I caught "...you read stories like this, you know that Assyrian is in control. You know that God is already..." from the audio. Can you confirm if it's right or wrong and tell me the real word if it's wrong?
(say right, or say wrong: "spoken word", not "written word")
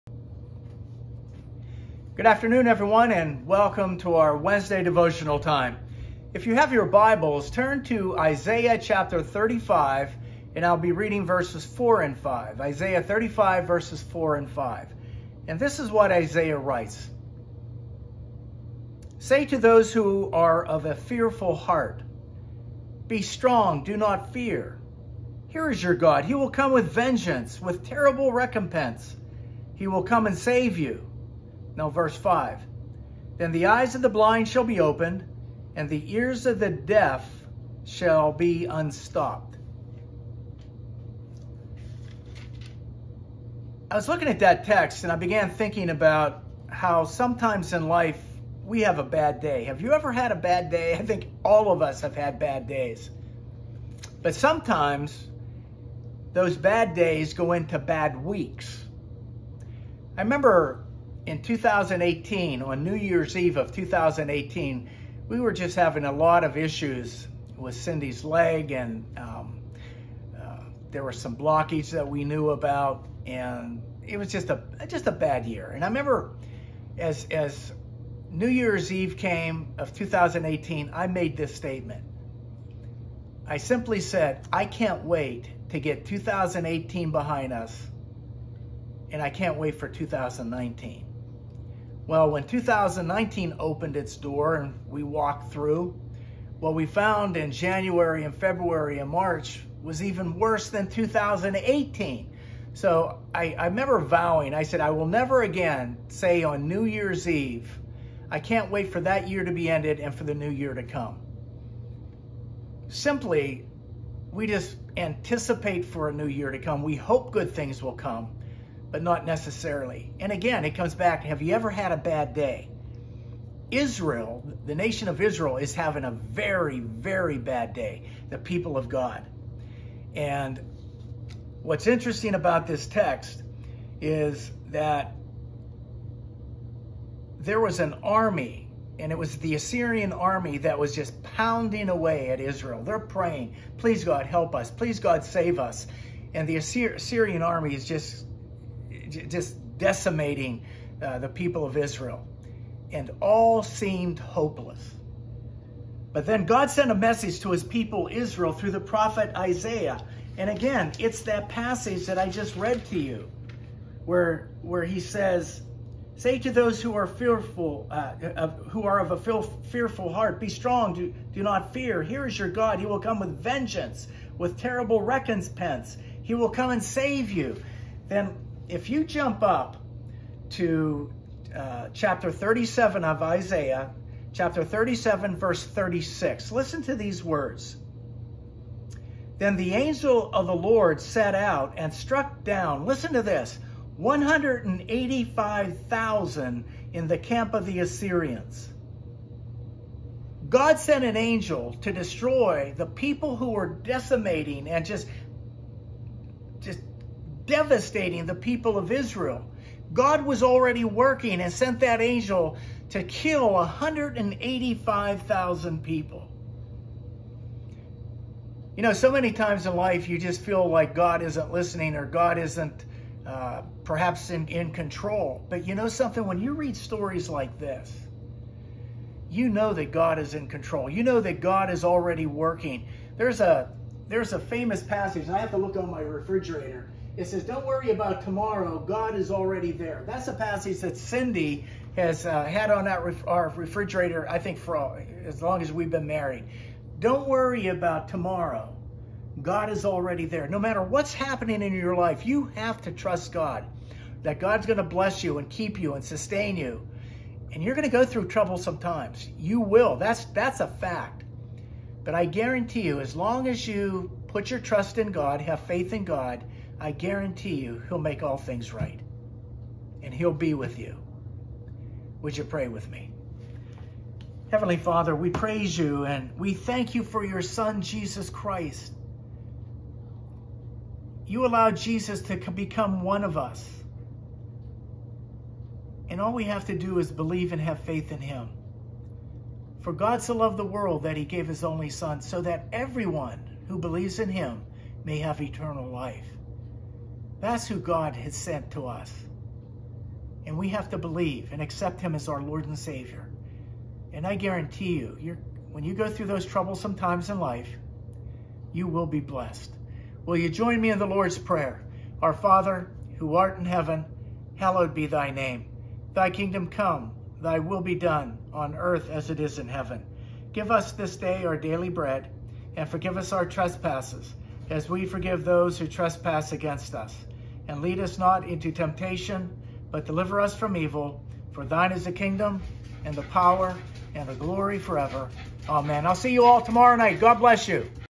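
wrong: "God", not "Assyrian".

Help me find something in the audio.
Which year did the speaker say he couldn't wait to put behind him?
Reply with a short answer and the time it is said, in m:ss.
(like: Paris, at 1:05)
2018, at 1:26.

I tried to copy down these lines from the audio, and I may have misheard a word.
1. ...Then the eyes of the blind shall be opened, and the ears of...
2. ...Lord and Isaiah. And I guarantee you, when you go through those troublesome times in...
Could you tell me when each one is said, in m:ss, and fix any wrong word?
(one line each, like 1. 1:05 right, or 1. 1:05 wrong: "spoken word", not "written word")
1. 0:33 right
2. 5:02 wrong: "Savior", not "Isaiah".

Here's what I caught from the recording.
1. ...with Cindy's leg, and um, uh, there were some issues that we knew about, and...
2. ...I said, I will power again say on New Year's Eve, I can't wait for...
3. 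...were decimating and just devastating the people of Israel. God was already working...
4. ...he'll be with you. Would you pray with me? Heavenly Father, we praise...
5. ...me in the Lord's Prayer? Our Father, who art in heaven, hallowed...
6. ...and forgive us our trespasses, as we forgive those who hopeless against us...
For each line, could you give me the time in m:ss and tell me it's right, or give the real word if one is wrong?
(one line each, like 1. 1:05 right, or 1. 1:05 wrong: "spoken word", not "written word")
1. 1:07 wrong: "blockages", not "issues"
2. 1:44 wrong: "never", not "power"
3. 3:23 right
4. 4:30 right
5. 5:10 right
6. 5:22 wrong: "trespass", not "hopeless".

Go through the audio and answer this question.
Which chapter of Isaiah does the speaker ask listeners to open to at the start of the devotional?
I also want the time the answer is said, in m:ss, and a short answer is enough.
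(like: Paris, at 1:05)
35, at 0:08.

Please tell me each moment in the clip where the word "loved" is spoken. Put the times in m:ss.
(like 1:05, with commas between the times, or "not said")
4:50.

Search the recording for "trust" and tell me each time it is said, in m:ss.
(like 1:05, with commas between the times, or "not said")
4:12, 4:24.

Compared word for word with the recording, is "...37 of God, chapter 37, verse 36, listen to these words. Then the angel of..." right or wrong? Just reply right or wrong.
wrong.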